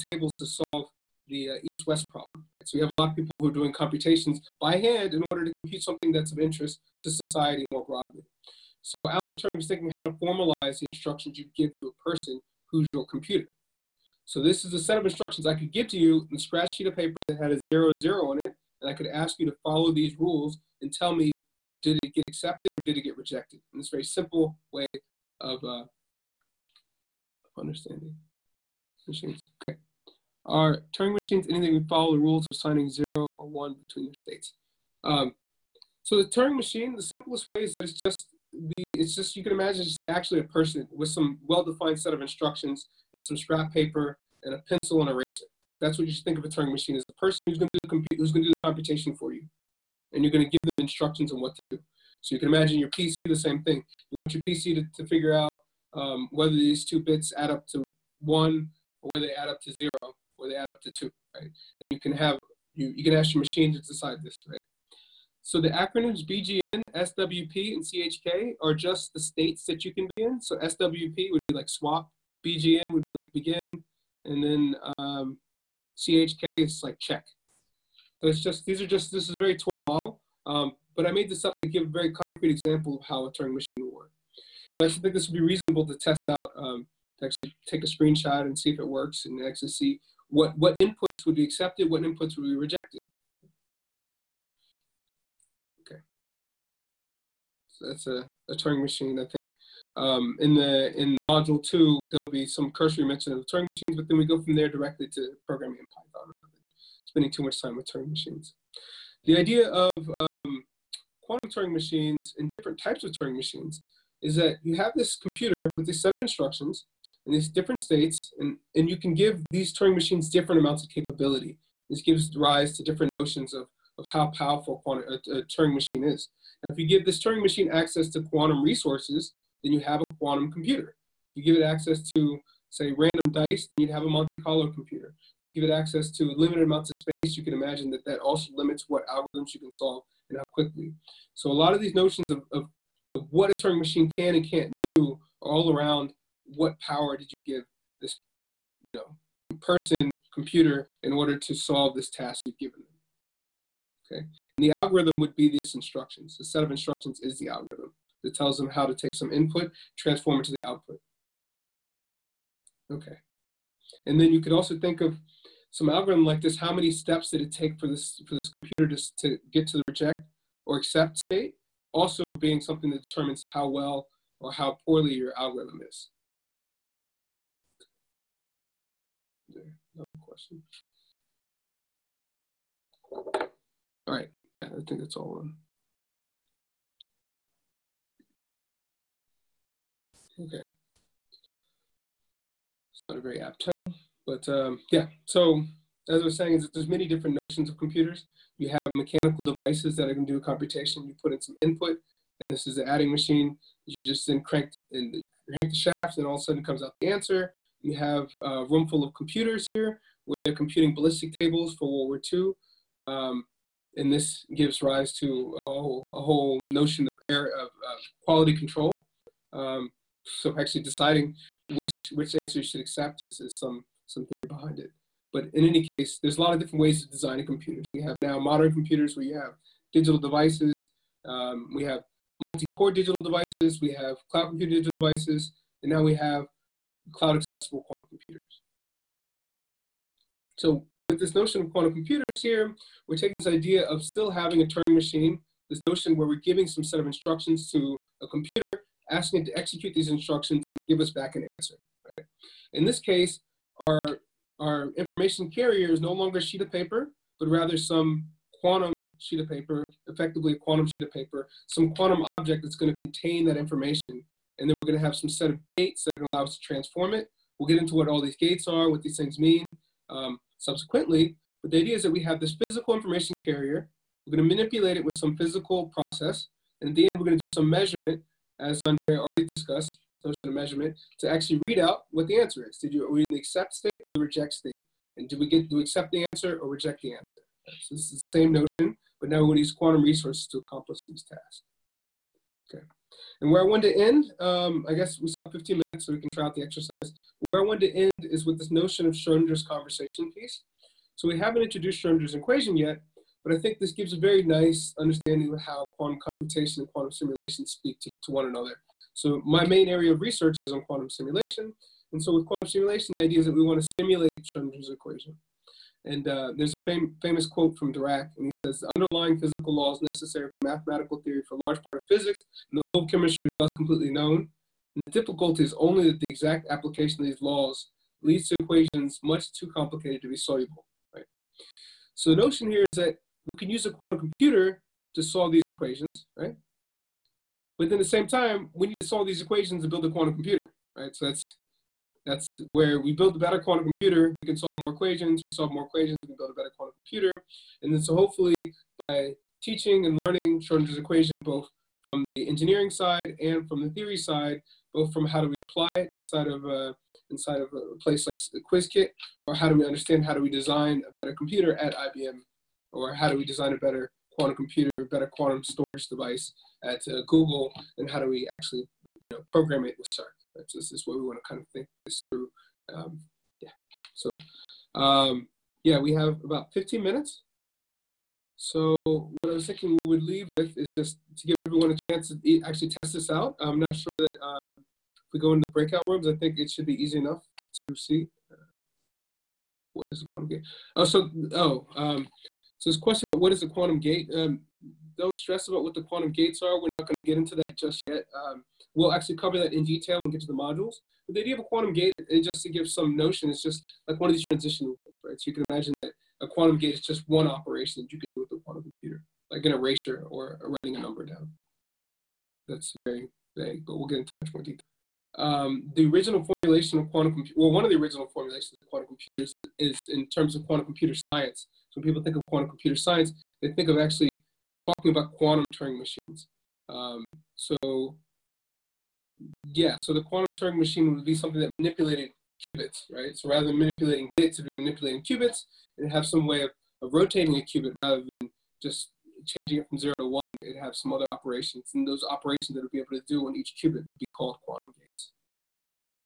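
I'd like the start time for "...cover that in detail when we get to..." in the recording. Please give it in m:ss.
6:39.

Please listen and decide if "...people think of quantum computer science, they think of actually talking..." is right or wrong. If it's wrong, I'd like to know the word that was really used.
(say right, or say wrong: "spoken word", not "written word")
right.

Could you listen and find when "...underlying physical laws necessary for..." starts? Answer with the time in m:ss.
5:18.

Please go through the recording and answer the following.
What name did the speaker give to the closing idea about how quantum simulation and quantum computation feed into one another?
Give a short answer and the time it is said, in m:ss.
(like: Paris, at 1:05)
Schrodinger's conversation piece, at 4:59.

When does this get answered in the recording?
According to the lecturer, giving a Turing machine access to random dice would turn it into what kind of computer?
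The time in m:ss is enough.
2:14.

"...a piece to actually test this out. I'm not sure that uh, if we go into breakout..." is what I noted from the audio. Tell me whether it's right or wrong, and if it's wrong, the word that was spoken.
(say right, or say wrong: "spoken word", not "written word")
wrong: "chance", not "piece".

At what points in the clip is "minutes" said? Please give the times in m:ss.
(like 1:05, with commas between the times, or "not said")
4:55, 6:17.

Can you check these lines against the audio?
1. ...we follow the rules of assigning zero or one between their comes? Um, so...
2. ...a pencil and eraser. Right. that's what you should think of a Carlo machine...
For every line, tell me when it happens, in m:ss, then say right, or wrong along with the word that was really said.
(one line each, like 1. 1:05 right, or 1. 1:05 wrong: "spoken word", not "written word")
1. 0:31 wrong: "states", not "comes"
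2. 0:44 wrong: "Turing", not "Carlo".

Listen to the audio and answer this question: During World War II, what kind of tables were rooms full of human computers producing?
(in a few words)
ballistic tables.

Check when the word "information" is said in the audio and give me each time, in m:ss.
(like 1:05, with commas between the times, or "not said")
4:14, 4:23, 4:32.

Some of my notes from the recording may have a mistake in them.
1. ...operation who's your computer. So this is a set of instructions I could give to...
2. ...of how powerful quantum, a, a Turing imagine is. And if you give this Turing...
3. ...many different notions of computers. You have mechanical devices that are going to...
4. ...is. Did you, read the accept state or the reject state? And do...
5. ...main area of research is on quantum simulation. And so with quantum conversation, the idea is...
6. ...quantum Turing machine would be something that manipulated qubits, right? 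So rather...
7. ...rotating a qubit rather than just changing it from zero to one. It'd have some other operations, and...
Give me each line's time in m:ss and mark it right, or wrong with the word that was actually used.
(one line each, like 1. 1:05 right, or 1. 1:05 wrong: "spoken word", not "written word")
1. 0:12 wrong: "person", not "operation"
2. 2:03 wrong: "machine", not "imagine"
3. 3:16 right
4. 4:42 right
5. 5:09 wrong: "simulation", not "conversation"
6. 7:10 right
7. 7:17 right.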